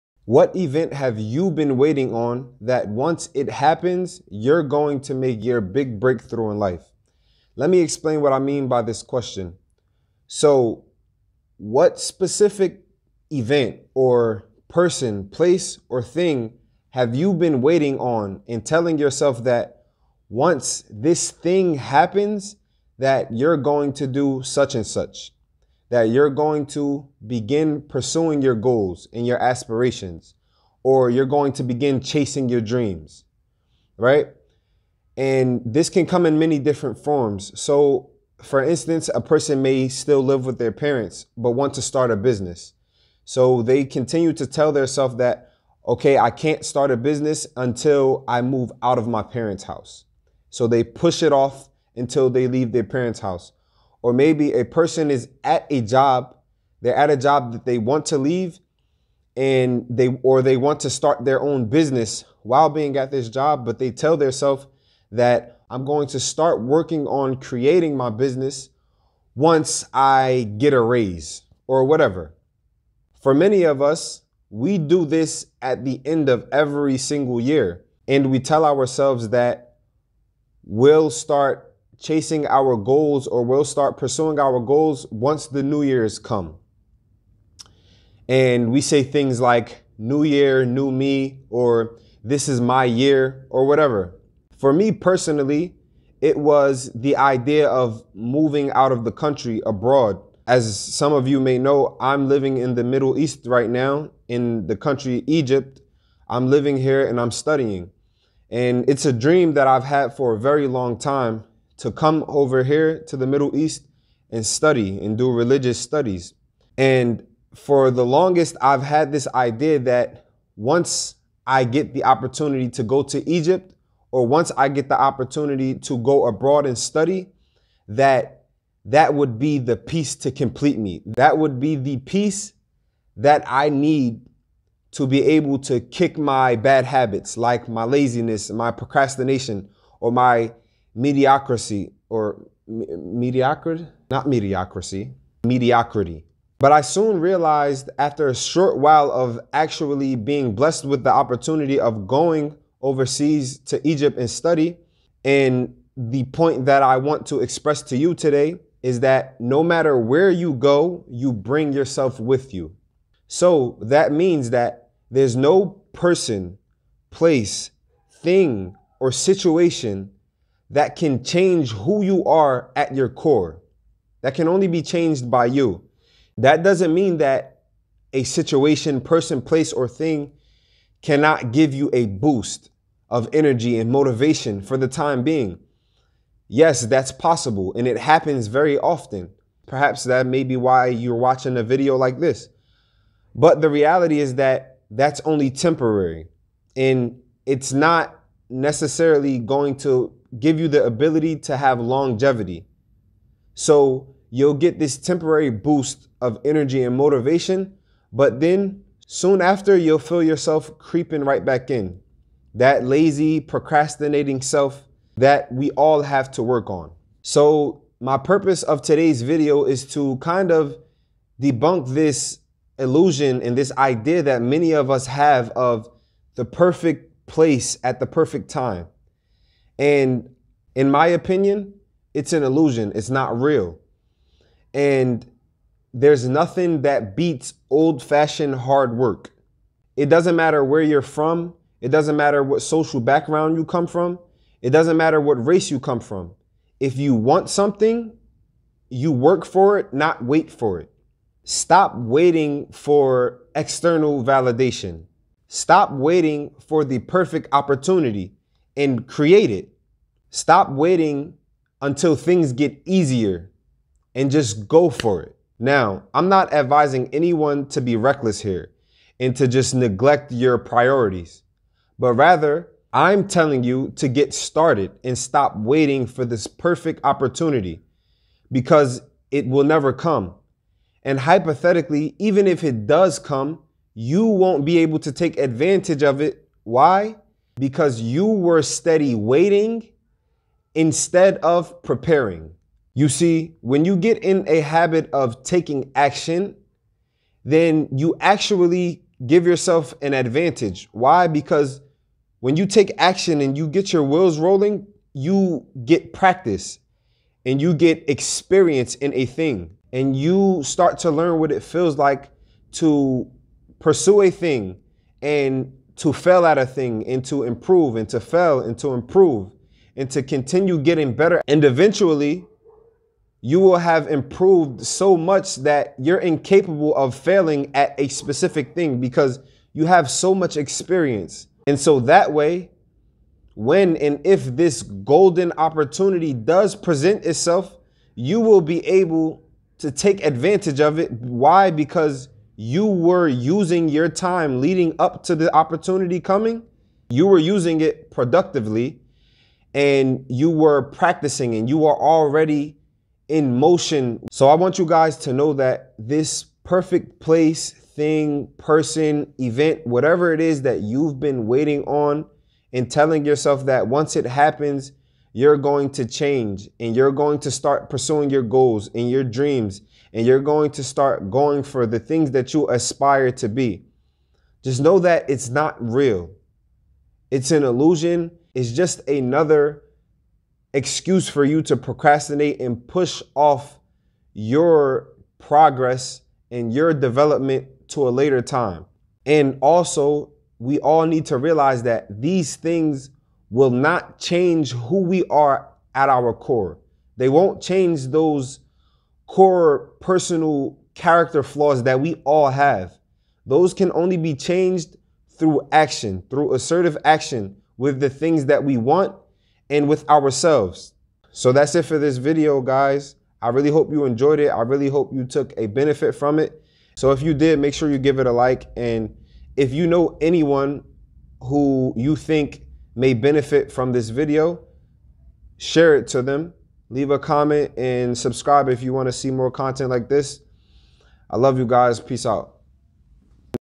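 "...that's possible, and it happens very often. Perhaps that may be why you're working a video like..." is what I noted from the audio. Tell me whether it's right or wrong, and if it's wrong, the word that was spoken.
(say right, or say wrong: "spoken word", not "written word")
wrong: "watching", not "working".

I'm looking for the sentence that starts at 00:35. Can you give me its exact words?
And this can come in many different forms.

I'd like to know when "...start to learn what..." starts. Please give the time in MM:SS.
05:10.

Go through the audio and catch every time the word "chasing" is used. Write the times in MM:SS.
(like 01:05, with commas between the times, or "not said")
00:31, 01:22.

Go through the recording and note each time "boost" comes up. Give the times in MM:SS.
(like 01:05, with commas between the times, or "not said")
03:02, 03:25.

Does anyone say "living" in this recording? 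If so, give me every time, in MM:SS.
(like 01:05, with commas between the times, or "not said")
01:42, 01:46.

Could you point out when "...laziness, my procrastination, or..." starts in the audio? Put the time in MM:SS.
02:17.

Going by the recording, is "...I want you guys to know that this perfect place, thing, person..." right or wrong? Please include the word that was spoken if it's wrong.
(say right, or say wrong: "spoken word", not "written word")
right.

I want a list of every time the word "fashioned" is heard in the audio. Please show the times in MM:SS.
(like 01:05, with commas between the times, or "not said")
03:58.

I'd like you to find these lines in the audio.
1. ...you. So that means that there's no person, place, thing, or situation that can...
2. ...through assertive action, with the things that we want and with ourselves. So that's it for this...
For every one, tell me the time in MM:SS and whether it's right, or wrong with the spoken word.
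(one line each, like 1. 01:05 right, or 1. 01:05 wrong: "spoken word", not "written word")
1. 02:42 right
2. 06:46 right.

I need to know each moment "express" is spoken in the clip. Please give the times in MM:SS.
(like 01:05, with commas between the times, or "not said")
02:37.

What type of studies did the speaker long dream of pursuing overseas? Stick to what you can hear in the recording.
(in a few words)
Religious studies.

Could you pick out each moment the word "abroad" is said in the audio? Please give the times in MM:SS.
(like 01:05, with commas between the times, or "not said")
01:39, 02:06.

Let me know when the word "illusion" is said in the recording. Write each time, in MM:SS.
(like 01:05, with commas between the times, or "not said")
03:42, 03:52, 06:17.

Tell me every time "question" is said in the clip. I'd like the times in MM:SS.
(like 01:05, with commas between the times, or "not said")
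00:09.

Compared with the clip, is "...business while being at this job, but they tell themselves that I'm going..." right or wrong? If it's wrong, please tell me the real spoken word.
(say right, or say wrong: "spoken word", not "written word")
right.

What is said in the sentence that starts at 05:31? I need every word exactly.
And so that way, when and if this golden opportunity does present itself, you will be able to take advantage of it.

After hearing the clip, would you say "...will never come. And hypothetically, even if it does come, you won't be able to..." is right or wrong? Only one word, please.
right.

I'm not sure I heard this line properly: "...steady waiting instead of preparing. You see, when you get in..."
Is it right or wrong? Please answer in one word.
right.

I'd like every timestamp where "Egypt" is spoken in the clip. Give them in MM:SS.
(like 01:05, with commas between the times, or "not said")
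01:45, 02:03, 02:33.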